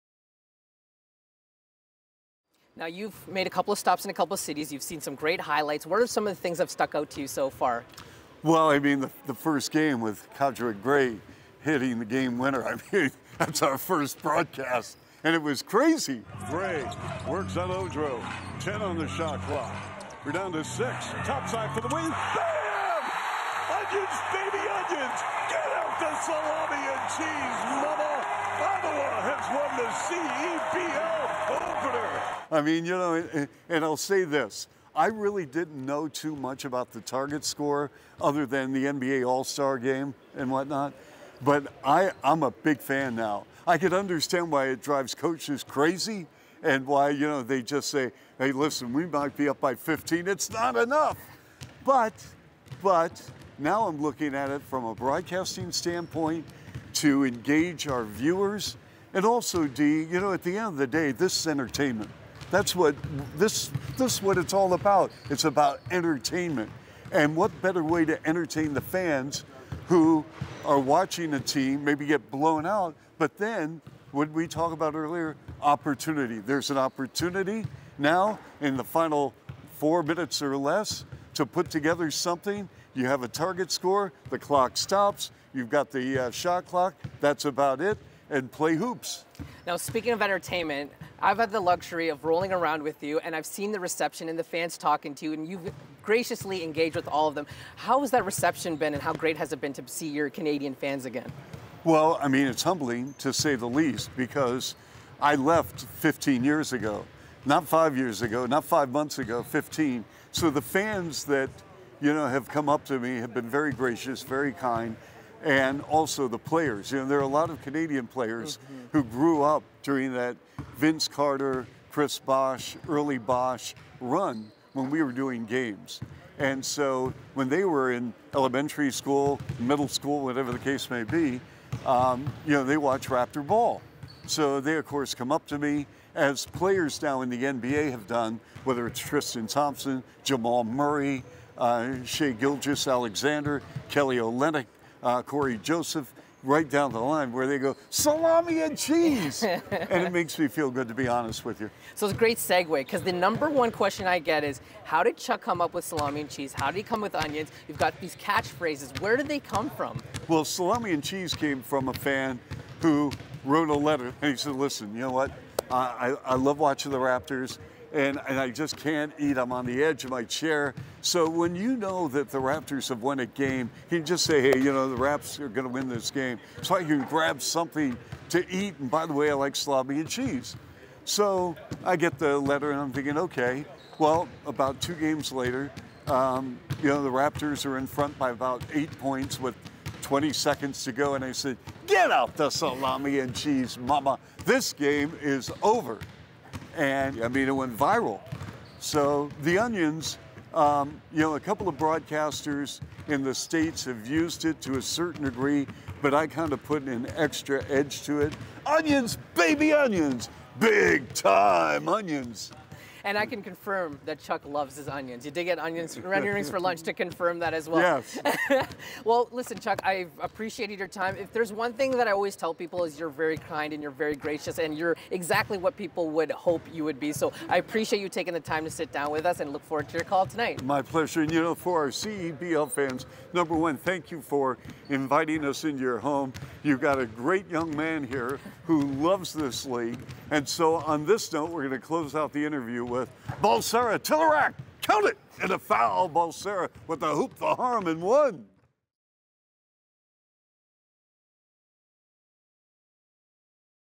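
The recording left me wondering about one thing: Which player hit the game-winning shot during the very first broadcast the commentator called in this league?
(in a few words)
Kadre Gray.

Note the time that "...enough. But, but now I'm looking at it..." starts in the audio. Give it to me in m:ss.
0:50.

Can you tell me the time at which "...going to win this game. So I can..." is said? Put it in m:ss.
2:55.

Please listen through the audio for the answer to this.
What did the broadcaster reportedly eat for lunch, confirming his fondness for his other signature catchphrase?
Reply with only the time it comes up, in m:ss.
3:36.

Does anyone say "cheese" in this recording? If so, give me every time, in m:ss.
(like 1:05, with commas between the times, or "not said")
0:27, 2:28, 2:36, 2:41, 3:00, 3:13.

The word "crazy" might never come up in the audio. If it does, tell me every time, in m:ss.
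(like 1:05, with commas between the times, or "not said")
0:15, 0:45.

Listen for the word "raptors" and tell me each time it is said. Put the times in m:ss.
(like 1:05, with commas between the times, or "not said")
2:13, 2:46, 2:52, 3:07.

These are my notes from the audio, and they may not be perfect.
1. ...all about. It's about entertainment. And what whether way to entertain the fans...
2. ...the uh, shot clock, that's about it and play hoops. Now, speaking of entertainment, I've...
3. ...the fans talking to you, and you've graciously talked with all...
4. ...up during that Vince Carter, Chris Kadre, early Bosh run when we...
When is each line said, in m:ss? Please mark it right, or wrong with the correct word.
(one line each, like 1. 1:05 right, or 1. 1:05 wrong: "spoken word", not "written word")
1. 1:04 wrong: "better", not "whether"
2. 1:25 right
3. 1:34 wrong: "engaged", not "talked"
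4. 1:59 wrong: "Bosh", not "Kadre".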